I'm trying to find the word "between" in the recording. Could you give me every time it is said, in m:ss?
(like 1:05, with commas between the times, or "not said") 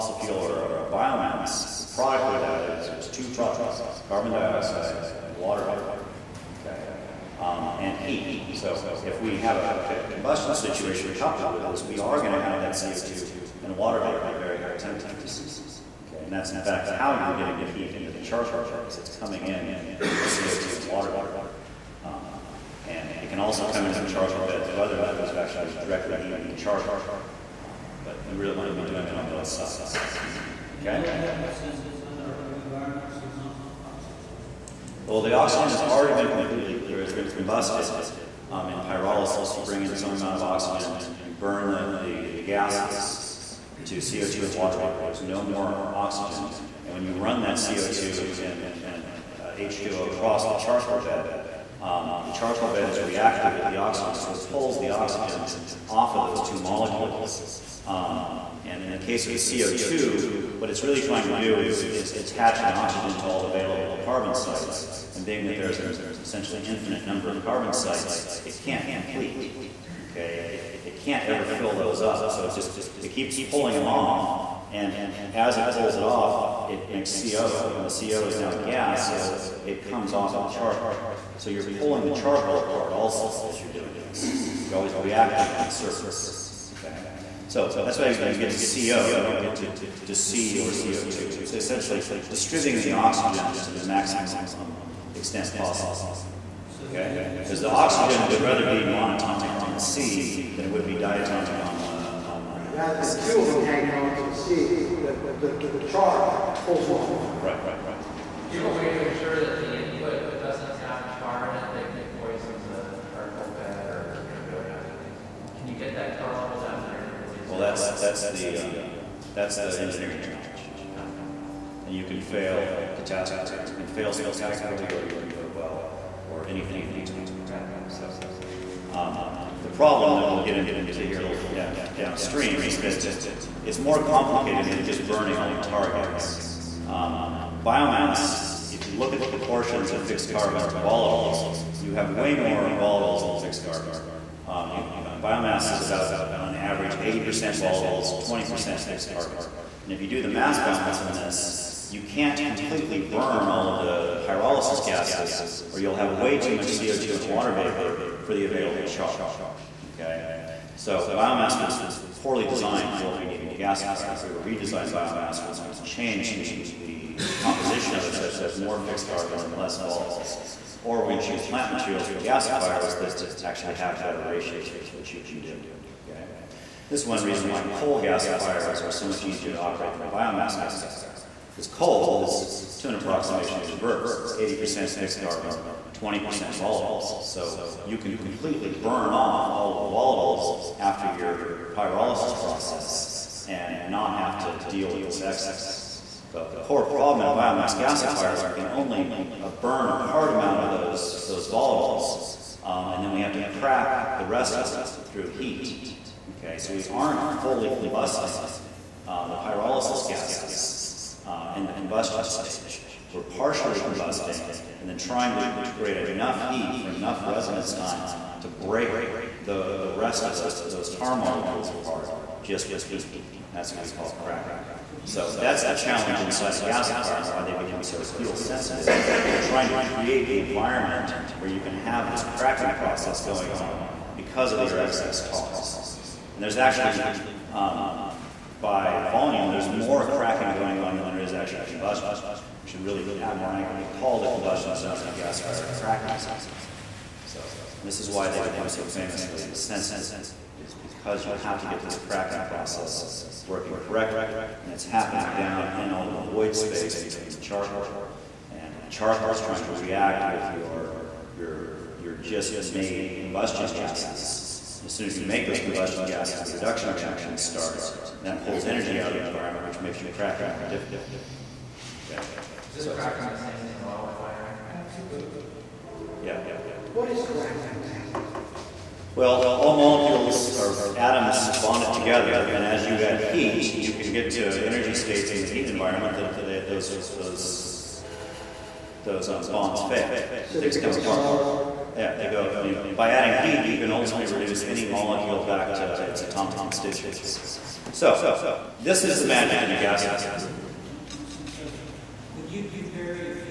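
2:07, 4:17.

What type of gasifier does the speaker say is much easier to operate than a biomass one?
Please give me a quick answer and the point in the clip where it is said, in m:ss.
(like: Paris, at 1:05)
Coal gasifiers, at 2:57.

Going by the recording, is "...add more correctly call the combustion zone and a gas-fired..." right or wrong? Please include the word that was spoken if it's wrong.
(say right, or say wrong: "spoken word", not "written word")
wrong: "accurately", not "correctly".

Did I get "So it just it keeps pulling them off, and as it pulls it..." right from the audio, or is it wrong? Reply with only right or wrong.
right.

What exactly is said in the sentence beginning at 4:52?
I mean, by adding heat, you can ultimately reduce any molecule back to its atomic constituents.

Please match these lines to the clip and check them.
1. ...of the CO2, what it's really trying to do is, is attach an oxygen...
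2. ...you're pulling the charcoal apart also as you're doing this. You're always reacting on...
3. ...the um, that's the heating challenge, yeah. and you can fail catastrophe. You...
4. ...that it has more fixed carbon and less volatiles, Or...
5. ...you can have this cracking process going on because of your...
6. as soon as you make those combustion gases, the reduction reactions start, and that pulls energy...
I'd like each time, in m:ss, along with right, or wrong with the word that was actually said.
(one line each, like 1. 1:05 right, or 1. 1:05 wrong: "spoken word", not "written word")
1. 0:59 right
2. 1:21 right
3. 1:58 wrong: "engineering", not "heating"
4. 2:48 right
5. 3:51 right
6. 4:24 right.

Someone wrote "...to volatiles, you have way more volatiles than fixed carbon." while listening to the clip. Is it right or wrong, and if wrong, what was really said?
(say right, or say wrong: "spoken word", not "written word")
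right.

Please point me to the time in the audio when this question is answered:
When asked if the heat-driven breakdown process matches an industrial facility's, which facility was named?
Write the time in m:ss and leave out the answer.
4:33.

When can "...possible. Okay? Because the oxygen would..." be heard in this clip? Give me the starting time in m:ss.
1:35.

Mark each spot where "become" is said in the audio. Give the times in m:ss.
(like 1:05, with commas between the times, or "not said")
3:47, 4:08.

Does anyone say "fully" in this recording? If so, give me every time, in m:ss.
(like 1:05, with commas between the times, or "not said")
3:27.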